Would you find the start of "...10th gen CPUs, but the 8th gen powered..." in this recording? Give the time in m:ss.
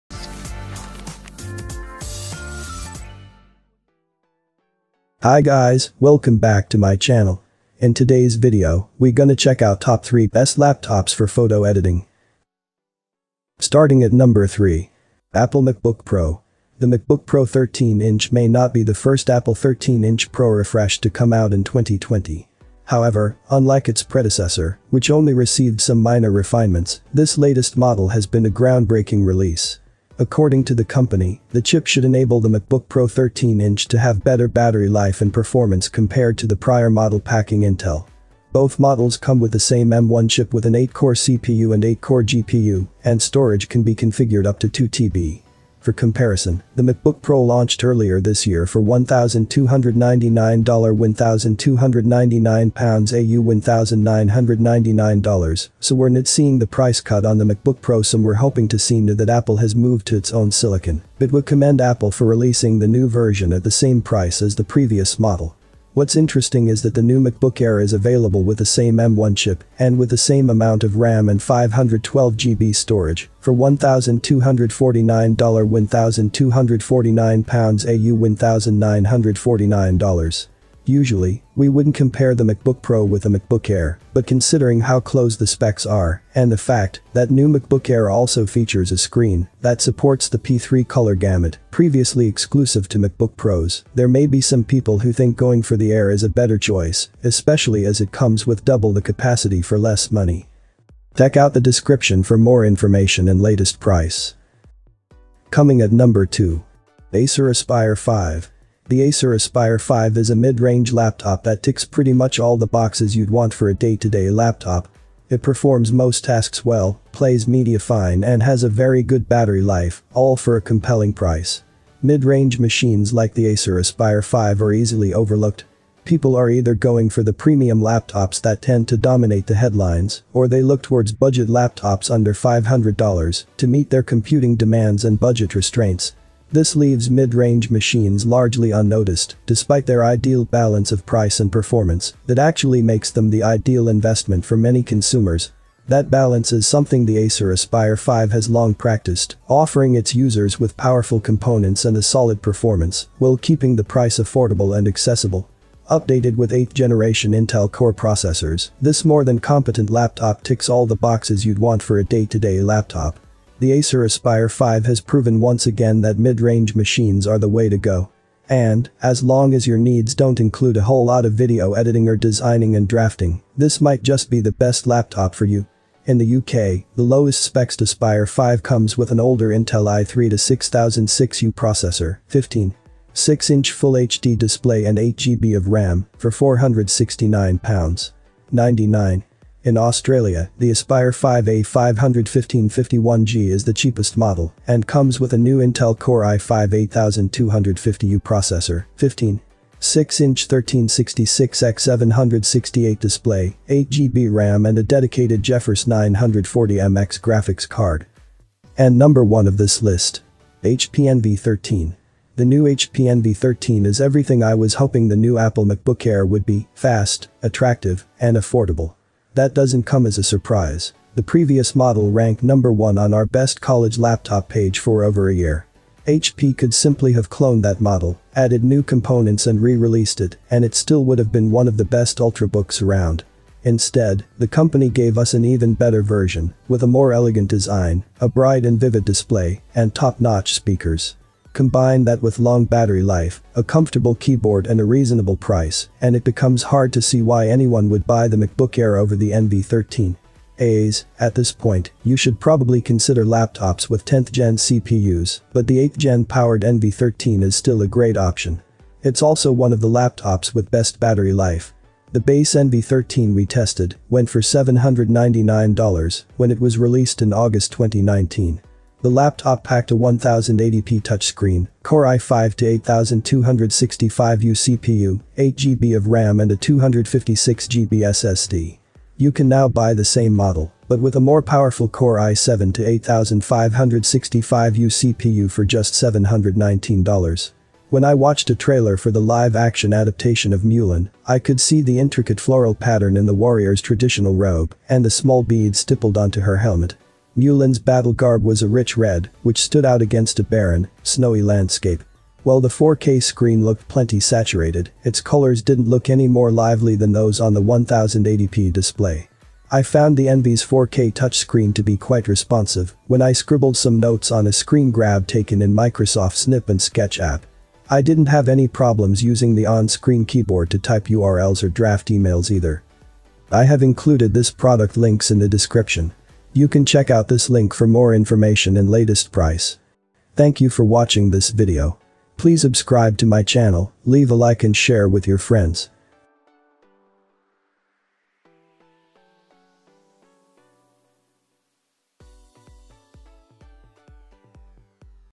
4:14.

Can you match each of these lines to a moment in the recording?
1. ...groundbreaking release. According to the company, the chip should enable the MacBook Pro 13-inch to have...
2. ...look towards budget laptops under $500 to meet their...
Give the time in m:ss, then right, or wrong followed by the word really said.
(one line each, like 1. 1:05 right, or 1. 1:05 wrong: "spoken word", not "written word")
1. 0:28 right
2. 2:10 right.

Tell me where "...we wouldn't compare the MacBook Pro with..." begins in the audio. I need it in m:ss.
1:21.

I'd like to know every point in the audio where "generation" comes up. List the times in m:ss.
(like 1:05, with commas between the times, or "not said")
2:36.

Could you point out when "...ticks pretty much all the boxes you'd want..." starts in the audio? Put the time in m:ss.
1:51.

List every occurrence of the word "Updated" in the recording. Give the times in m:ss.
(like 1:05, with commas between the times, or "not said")
2:35.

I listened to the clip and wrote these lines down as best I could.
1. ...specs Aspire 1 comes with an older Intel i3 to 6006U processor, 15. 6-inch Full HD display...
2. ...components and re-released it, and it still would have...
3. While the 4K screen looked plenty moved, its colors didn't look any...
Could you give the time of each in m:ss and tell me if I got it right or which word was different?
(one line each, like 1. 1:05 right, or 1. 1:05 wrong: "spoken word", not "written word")
1. 2:57 wrong: "5", not "1"
2. 3:48 right
3. 5:02 wrong: "saturated", not "moved".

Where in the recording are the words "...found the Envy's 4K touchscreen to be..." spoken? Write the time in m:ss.
5:09.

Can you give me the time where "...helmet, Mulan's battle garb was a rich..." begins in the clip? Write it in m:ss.
4:56.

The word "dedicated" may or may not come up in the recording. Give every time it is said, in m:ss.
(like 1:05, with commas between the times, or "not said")
3:24.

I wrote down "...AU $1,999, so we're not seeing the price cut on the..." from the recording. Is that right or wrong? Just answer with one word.
right.